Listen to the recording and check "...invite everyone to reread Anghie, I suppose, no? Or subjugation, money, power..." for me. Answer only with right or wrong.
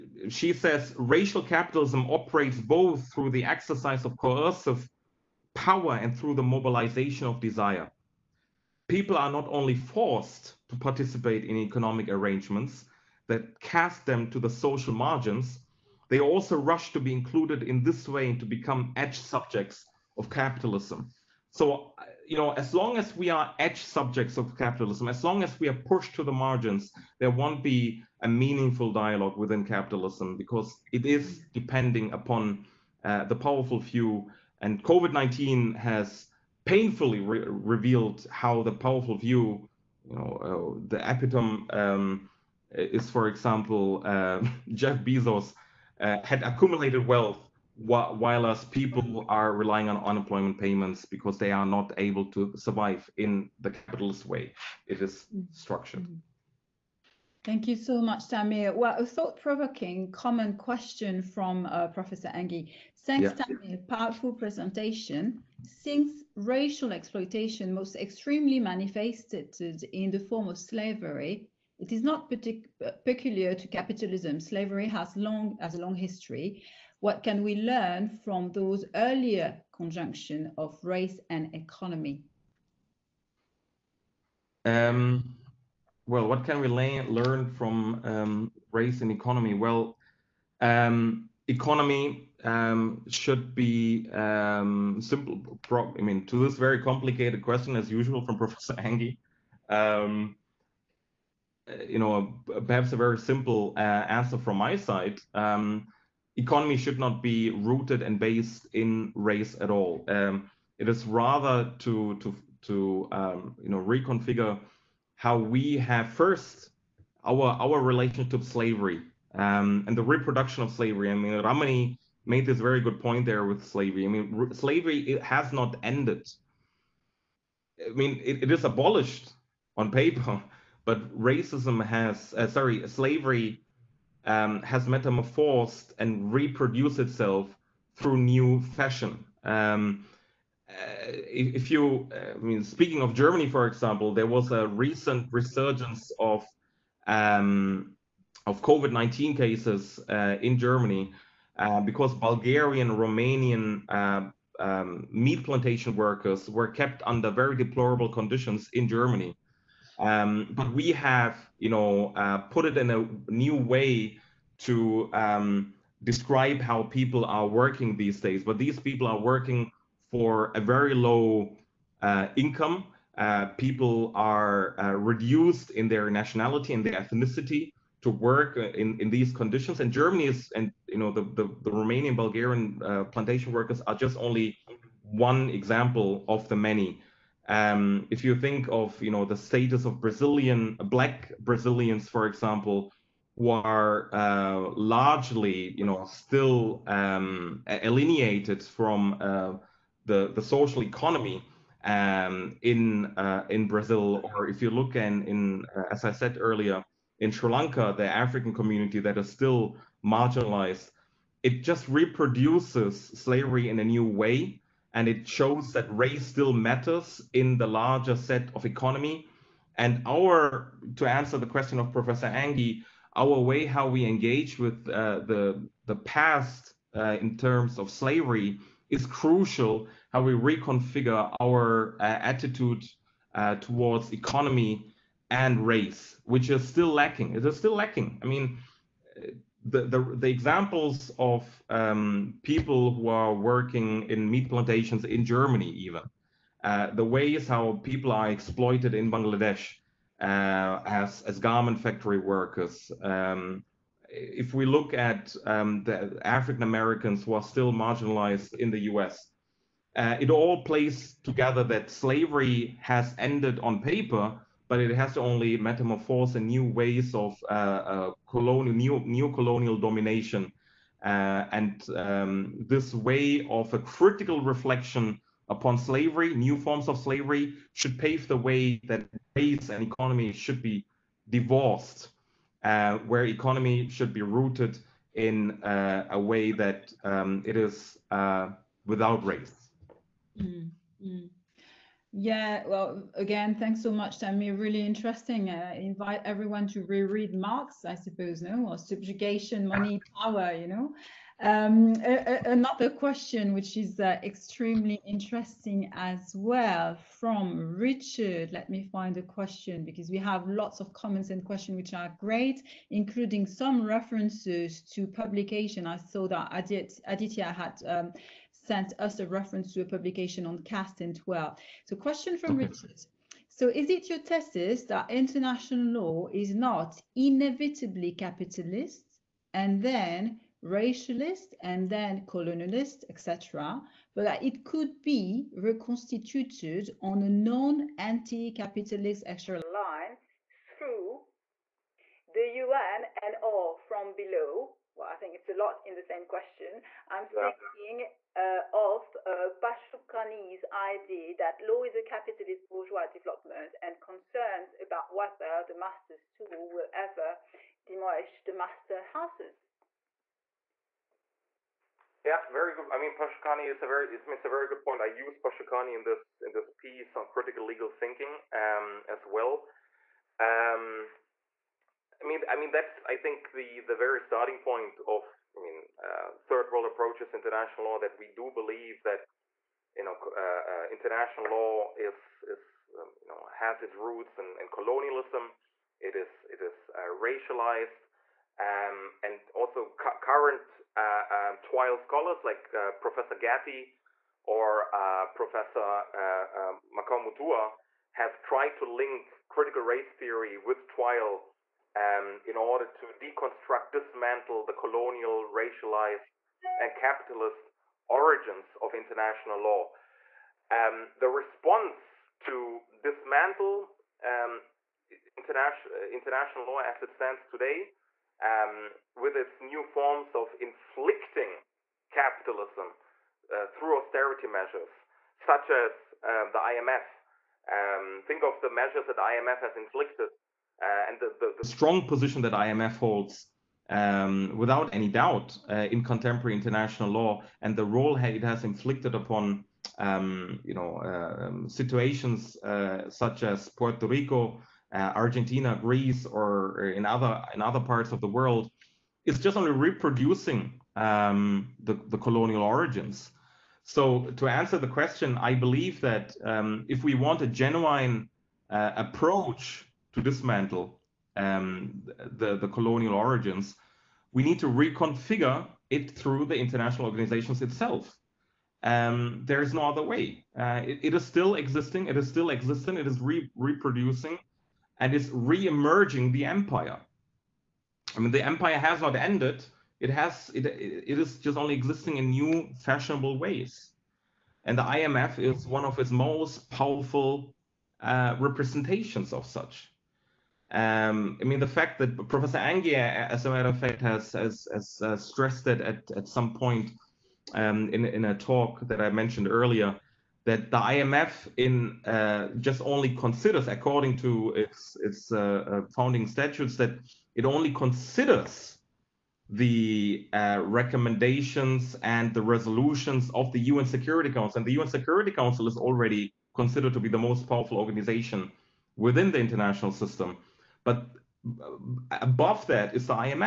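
wrong.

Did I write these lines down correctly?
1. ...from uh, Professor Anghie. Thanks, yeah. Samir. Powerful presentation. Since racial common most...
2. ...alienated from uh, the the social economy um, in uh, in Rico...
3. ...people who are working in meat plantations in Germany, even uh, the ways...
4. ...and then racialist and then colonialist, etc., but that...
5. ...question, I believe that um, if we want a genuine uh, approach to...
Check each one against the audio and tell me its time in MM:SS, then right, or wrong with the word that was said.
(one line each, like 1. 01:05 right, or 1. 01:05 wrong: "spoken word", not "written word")
1. 01:01 wrong: "exploitation", not "common"
2. 03:17 wrong: "Brazil", not "Rico"
3. 04:02 right
4. 05:29 right
5. 07:34 right.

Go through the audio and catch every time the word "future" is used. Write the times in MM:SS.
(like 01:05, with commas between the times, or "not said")
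not said.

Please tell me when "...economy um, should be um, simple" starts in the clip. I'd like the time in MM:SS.
01:31.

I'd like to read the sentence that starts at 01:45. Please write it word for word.
Um, economy should not be rooted and based in race at all.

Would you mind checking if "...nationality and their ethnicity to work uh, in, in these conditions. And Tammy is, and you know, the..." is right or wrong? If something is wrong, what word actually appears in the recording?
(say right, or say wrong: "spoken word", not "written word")
wrong: "Germany", not "Tammy".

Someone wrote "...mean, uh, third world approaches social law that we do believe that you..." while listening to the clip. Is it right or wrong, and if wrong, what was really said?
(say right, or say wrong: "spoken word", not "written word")
wrong: "international", not "social".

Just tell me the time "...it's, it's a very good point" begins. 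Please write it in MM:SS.
06:04.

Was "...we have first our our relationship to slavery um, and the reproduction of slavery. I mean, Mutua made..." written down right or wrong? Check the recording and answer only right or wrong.
wrong.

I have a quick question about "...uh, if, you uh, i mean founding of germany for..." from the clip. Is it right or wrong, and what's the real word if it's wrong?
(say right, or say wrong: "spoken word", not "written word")
wrong: "speaking", not "founding".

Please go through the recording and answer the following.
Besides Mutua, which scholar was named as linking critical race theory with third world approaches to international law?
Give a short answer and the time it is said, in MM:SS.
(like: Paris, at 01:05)
Gathii, at 06:33.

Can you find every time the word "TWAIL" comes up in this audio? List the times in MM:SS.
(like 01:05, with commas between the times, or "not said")
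06:31, 06:40.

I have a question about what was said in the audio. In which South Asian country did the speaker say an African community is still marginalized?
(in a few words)
Sri Lanka.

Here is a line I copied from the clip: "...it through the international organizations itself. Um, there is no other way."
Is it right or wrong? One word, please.
right.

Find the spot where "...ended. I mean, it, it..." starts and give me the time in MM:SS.
02:05.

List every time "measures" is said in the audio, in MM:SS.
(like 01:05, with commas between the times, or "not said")
07:04, 07:08.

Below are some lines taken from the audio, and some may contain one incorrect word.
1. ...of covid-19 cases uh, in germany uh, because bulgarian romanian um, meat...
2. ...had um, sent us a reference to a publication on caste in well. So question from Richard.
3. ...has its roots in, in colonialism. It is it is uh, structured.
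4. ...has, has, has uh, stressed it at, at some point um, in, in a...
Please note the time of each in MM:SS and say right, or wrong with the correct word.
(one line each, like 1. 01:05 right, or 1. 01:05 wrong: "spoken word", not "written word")
1. 02:28 right
2. 05:17 right
3. 06:23 wrong: "racialized", not "structured"
4. 08:13 right.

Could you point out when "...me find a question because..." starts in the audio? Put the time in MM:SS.
05:08.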